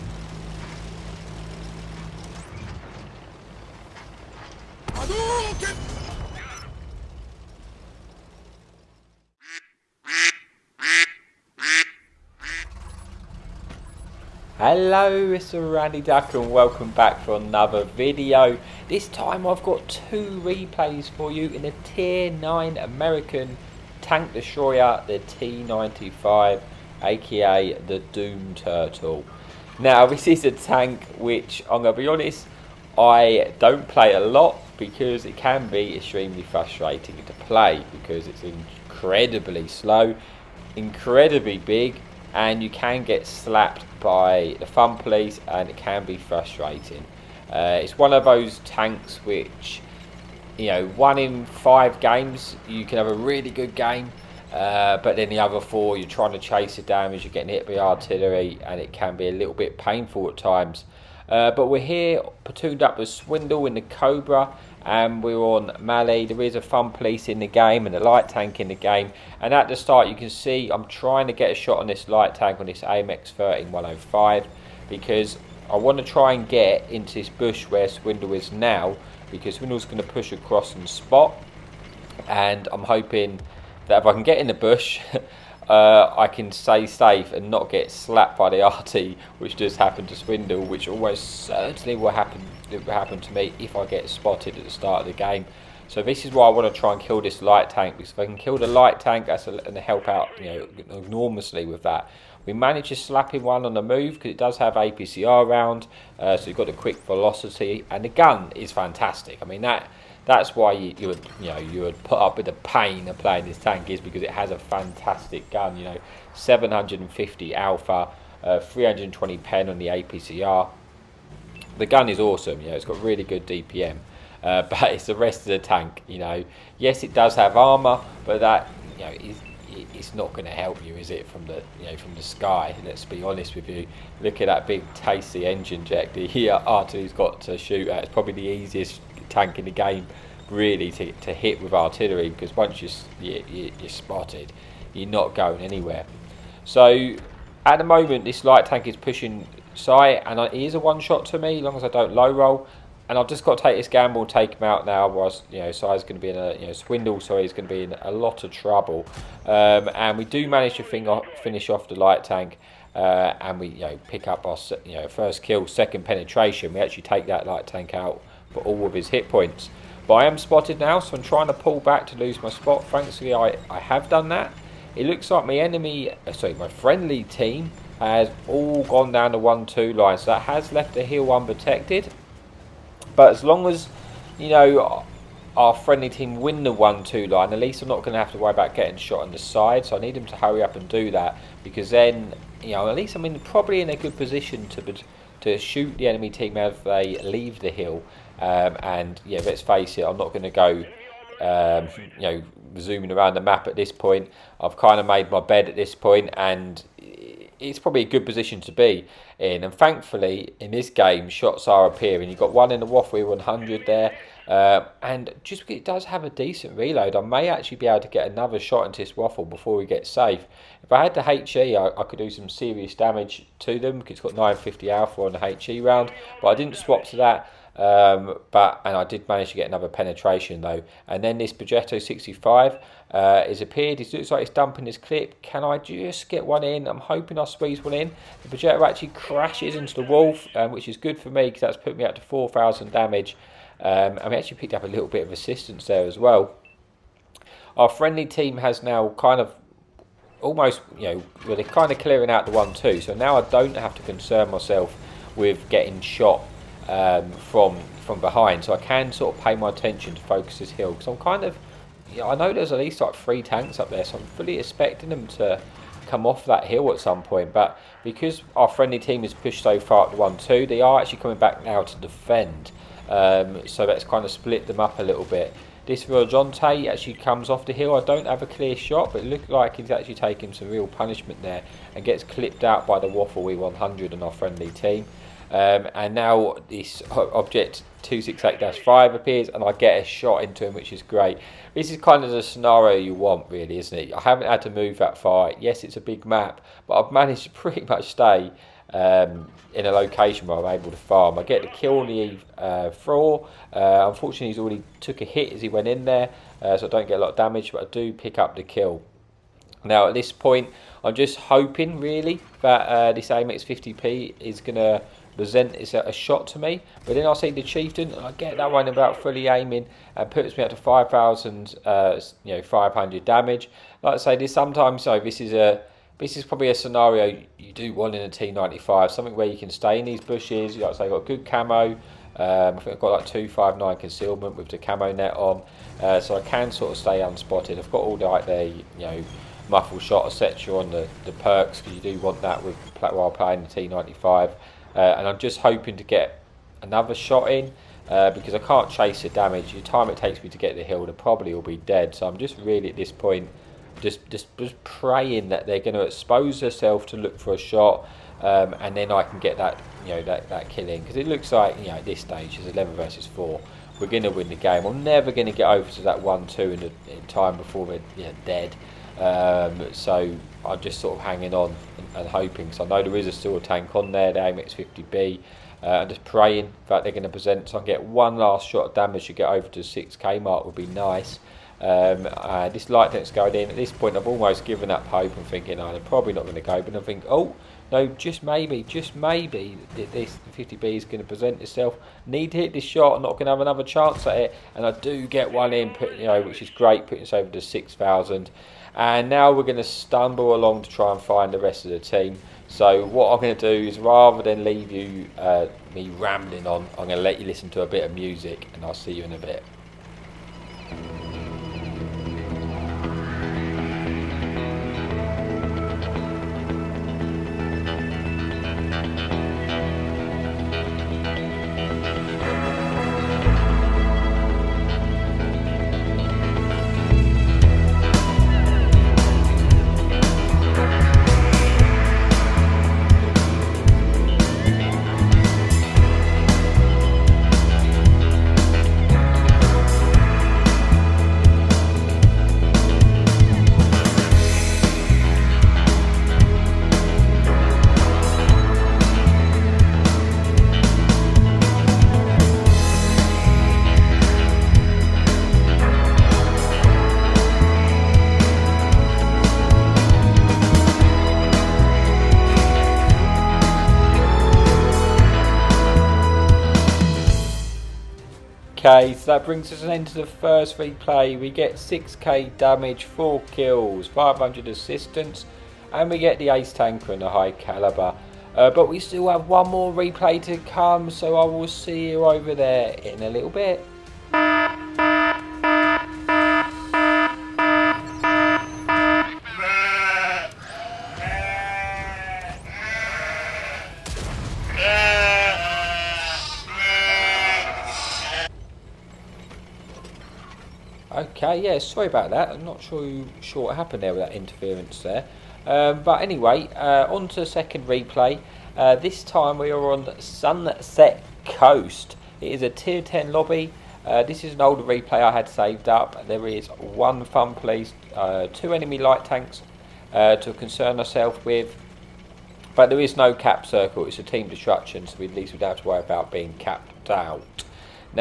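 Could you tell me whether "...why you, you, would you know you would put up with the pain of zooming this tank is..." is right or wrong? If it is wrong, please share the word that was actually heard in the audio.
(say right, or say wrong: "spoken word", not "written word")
wrong: "playing", not "zooming".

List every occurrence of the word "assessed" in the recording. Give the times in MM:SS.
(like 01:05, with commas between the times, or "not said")
not said.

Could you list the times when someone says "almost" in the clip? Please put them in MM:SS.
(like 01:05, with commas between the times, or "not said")
01:30, 04:10, 06:24.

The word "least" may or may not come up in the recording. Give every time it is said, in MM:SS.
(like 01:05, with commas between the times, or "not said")
03:07, 03:12, 04:22, 08:45.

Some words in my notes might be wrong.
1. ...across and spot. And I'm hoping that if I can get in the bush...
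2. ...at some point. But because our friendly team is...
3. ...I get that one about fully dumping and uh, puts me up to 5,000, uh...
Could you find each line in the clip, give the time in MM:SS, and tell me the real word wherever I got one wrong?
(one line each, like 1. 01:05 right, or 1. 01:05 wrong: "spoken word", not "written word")
1. 01:20 right
2. 04:26 right
3. 05:18 wrong: "aiming", not "dumping".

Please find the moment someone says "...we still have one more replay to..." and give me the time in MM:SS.
07:58.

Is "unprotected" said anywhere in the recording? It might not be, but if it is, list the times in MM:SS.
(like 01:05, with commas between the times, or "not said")
03:01.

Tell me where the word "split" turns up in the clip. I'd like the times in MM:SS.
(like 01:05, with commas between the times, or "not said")
04:34.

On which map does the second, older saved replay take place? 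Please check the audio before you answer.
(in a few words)
Sunset Coast.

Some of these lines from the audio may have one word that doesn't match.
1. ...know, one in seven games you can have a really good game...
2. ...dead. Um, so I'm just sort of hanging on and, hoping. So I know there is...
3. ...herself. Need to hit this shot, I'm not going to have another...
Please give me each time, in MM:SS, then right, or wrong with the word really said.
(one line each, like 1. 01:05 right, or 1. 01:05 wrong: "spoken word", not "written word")
1. 00:50 wrong: "five", not "seven"
2. 06:08 right
3. 06:31 wrong: "itself", not "herself".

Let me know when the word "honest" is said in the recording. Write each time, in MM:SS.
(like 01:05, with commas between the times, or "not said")
00:32, 02:13.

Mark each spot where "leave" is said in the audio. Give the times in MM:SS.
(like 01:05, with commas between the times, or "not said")
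03:17, 06:44.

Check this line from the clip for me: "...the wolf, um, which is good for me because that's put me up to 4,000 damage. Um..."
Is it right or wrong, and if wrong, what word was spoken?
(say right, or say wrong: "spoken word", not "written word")
right.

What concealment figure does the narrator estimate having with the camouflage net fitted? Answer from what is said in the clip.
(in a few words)
259.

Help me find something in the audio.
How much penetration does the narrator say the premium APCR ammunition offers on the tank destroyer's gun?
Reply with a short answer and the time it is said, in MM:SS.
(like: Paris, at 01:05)
320, at 01:58.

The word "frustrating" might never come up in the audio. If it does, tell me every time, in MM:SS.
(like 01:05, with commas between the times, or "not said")
00:36, 00:46.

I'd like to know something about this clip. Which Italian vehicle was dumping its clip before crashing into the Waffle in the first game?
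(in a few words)
Progetto 65.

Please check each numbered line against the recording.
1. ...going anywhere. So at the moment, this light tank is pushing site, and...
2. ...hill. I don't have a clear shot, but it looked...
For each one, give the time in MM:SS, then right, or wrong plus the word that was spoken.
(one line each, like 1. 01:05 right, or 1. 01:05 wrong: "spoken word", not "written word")
1. 02:25 right
2. 04:37 right.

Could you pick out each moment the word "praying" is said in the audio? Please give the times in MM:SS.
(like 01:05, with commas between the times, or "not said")
05:54, 06:16.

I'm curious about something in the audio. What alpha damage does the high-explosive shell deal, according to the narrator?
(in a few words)
950.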